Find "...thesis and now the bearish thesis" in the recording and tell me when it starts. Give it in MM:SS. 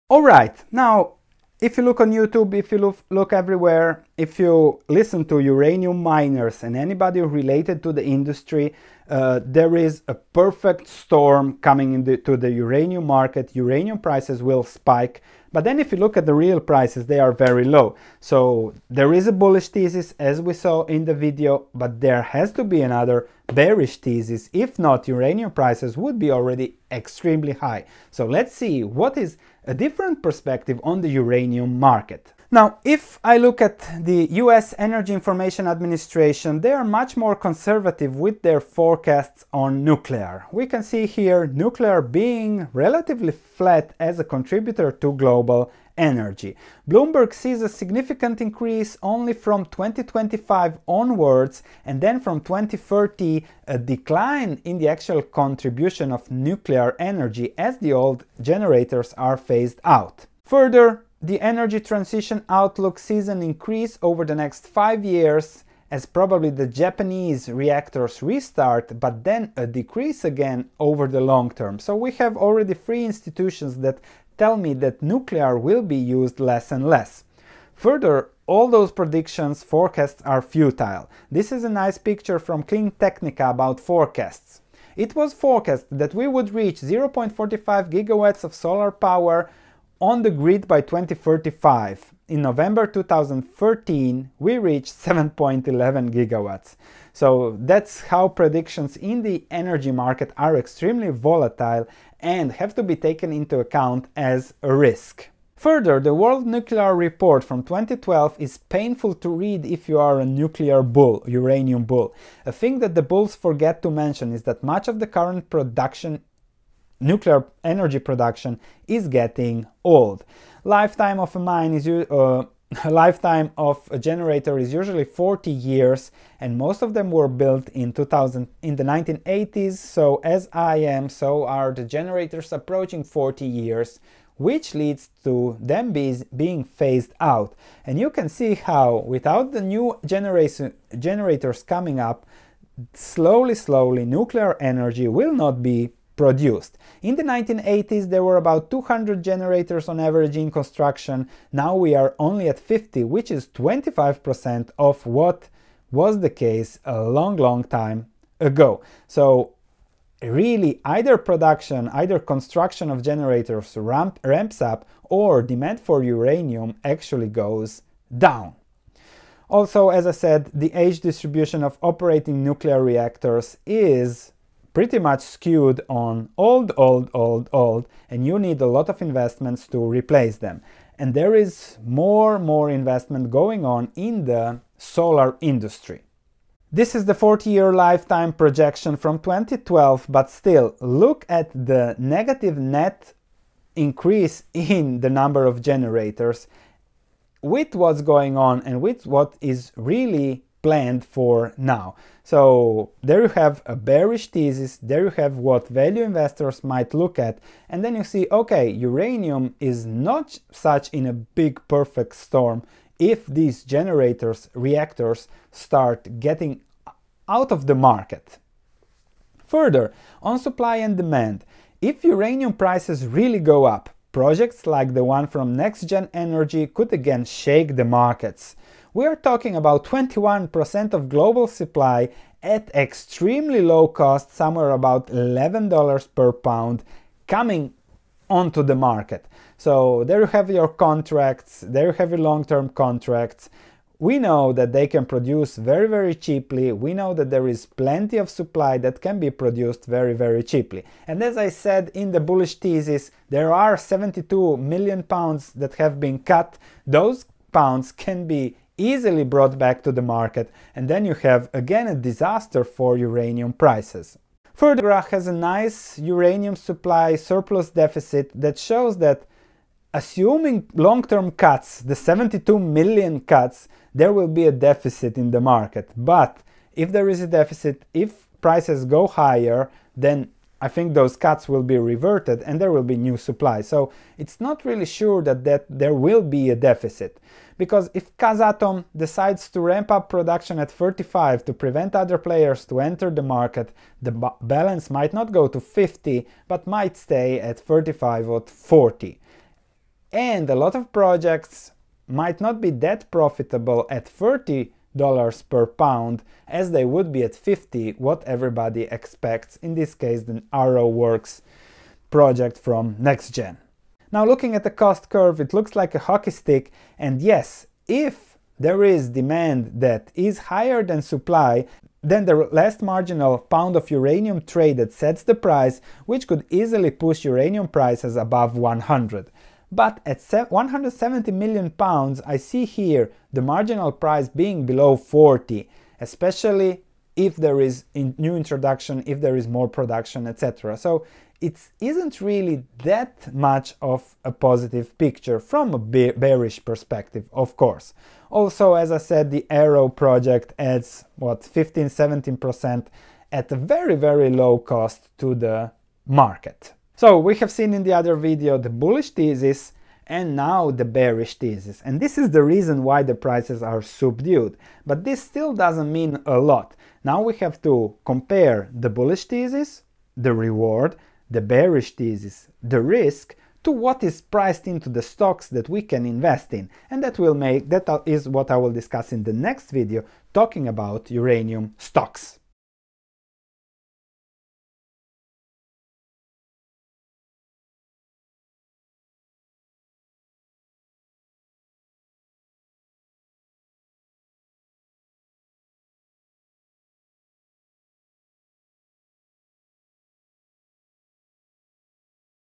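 05:59.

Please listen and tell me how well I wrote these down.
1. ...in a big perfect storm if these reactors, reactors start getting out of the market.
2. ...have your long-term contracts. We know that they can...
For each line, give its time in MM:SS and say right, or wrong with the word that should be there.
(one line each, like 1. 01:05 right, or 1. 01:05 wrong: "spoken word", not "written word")
1. 03:30 wrong: "generators", not "reactors"
2. 04:01 right.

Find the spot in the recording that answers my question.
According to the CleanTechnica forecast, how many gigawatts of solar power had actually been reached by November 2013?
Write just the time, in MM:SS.
01:34.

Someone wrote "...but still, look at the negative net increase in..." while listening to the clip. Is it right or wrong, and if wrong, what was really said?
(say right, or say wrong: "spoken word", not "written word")
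right.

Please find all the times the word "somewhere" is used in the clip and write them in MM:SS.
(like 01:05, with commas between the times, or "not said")
03:54.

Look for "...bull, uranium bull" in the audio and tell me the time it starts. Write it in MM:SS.
01:50.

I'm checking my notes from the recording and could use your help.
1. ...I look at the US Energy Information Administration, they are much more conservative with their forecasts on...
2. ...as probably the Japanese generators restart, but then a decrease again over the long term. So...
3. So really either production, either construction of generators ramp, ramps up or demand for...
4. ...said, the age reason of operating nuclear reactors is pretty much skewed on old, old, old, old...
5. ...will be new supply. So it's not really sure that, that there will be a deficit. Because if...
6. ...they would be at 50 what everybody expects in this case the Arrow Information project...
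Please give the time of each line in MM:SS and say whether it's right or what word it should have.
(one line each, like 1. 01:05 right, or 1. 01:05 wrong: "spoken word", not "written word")
1. 00:33 right
2. 01:05 wrong: "reactors", not "generators"
3. 02:39 right
4. 02:50 wrong: "distribution", not "reason"
5. 04:42 right
6. 05:06 wrong: "Works", not "Information".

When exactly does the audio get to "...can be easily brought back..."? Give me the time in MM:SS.
04:17.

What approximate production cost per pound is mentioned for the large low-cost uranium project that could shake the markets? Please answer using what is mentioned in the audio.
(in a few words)
$11.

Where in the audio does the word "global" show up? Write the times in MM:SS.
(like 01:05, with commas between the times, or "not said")
00:45, 03:51.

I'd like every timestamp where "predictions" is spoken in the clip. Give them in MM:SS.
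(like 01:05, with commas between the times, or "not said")
01:18, 01:38.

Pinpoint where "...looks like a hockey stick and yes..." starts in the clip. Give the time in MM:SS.
05:15.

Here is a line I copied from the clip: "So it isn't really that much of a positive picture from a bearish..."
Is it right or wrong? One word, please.
right.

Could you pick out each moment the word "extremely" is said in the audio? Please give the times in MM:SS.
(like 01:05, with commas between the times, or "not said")
00:26, 01:40, 03:52.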